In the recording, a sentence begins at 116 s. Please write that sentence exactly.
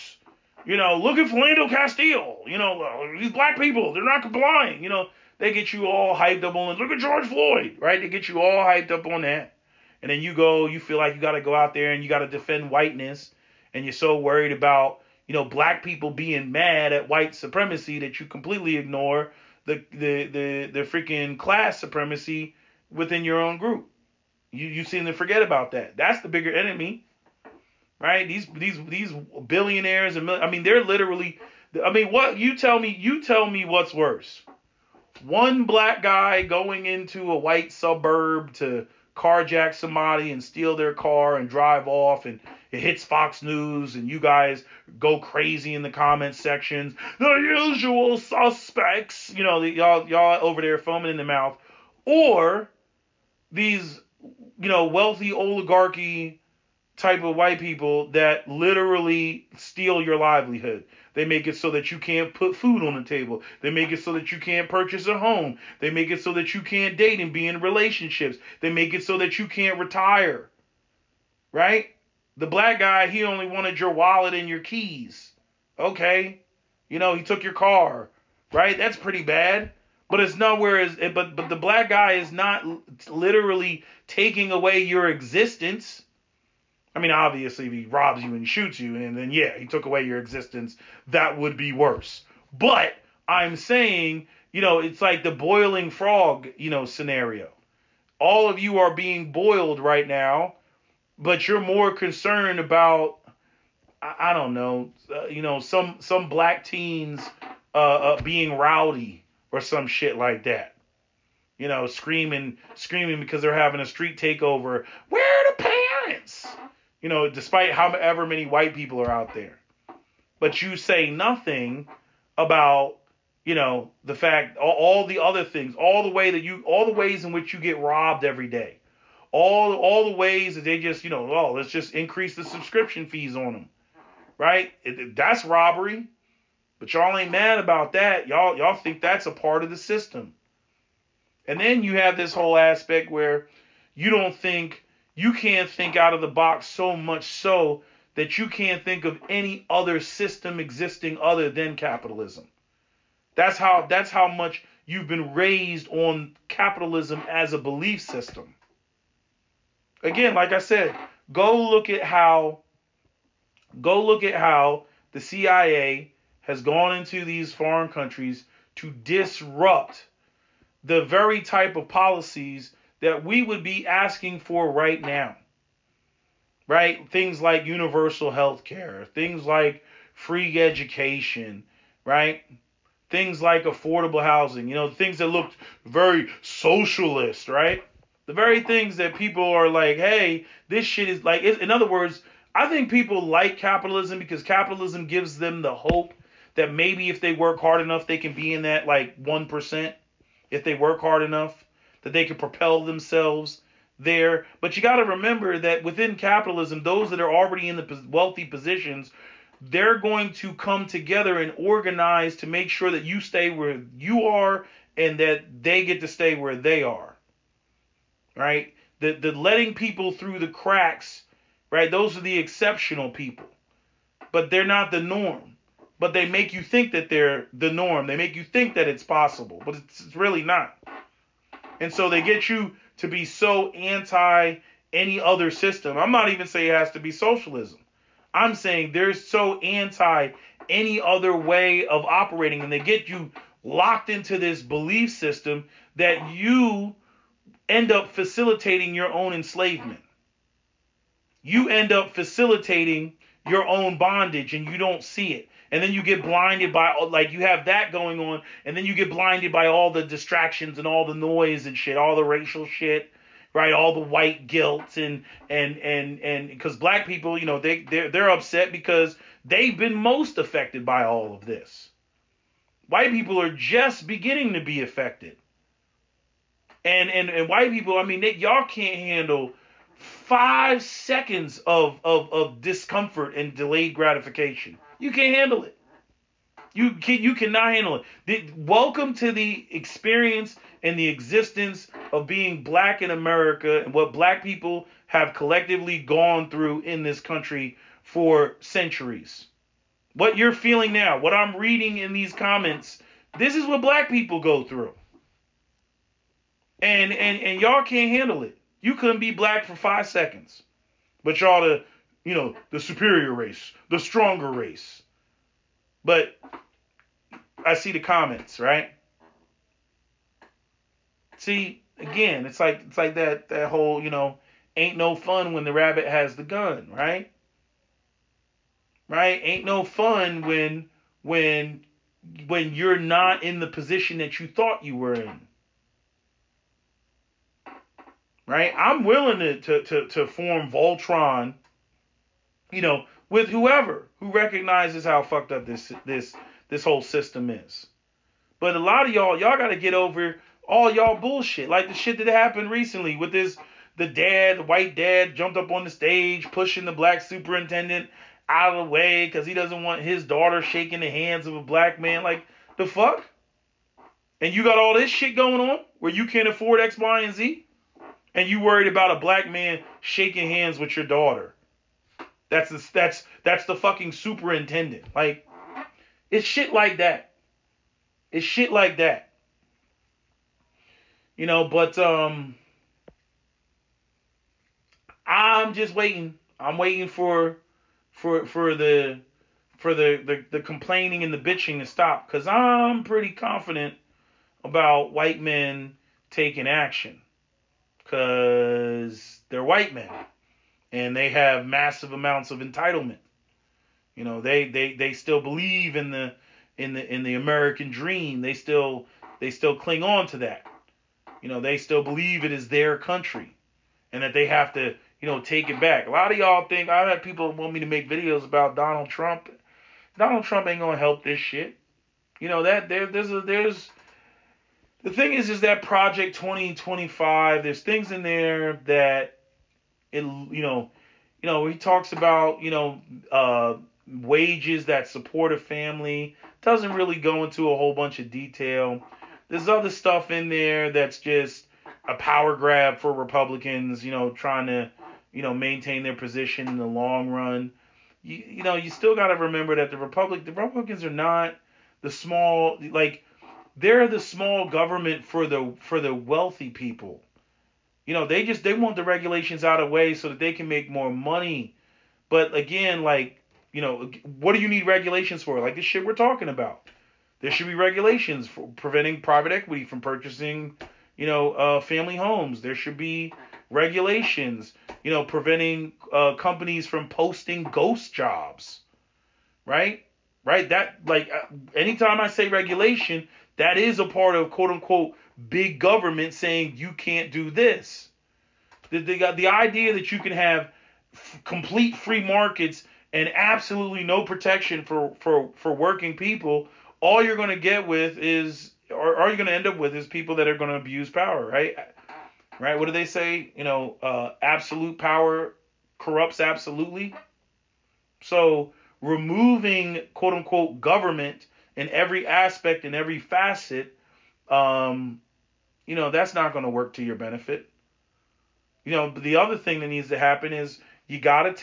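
You know, despite however many white people are out there.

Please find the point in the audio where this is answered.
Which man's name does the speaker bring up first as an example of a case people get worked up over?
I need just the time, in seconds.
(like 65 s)
1 s.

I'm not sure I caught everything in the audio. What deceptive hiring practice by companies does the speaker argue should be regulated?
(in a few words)
Ghost jobs.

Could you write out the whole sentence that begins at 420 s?
Donald Trump ain't gonna help this shit.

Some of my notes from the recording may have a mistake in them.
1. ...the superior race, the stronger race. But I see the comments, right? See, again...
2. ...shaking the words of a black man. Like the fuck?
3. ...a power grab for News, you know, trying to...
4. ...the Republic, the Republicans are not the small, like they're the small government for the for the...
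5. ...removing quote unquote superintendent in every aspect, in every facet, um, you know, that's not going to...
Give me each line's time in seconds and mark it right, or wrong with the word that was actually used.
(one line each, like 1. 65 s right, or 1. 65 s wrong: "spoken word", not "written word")
1. 312 s right
2. 360 s wrong: "hands", not "words"
3. 442 s wrong: "Republicans", not "News"
4. 449 s right
5. 508 s wrong: "government", not "superintendent".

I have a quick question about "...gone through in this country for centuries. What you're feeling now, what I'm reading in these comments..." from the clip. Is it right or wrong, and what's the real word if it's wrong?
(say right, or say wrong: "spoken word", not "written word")
right.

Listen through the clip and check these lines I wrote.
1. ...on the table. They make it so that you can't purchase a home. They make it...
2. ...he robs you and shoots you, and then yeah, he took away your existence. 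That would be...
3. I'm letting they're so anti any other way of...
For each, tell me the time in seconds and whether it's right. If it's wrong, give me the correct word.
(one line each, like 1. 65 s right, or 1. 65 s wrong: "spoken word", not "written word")
1. 62 s right
2. 87 s right
3. 238 s wrong: "saying", not "letting".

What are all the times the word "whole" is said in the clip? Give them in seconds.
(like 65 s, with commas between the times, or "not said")
142 s, 323 s, 346 s, 437 s.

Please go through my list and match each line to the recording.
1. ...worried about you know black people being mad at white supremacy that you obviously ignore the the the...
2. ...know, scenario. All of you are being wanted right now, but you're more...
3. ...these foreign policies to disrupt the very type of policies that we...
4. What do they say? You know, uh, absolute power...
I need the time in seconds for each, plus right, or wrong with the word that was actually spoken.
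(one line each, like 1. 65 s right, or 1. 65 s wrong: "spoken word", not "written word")
1. 14 s wrong: "completely", not "obviously"
2. 96 s wrong: "boiled", not "wanted"
3. 167 s wrong: "countries", not "policies"
4. 502 s right.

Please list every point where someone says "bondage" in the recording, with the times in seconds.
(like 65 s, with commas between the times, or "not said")
253 s.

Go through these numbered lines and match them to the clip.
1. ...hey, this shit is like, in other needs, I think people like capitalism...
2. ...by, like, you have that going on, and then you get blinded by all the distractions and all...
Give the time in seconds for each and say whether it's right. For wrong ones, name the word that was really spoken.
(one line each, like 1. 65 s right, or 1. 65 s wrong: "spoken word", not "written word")
1. 189 s wrong: "words", not "needs"
2. 256 s right.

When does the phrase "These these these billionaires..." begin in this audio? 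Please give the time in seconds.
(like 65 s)
28 s.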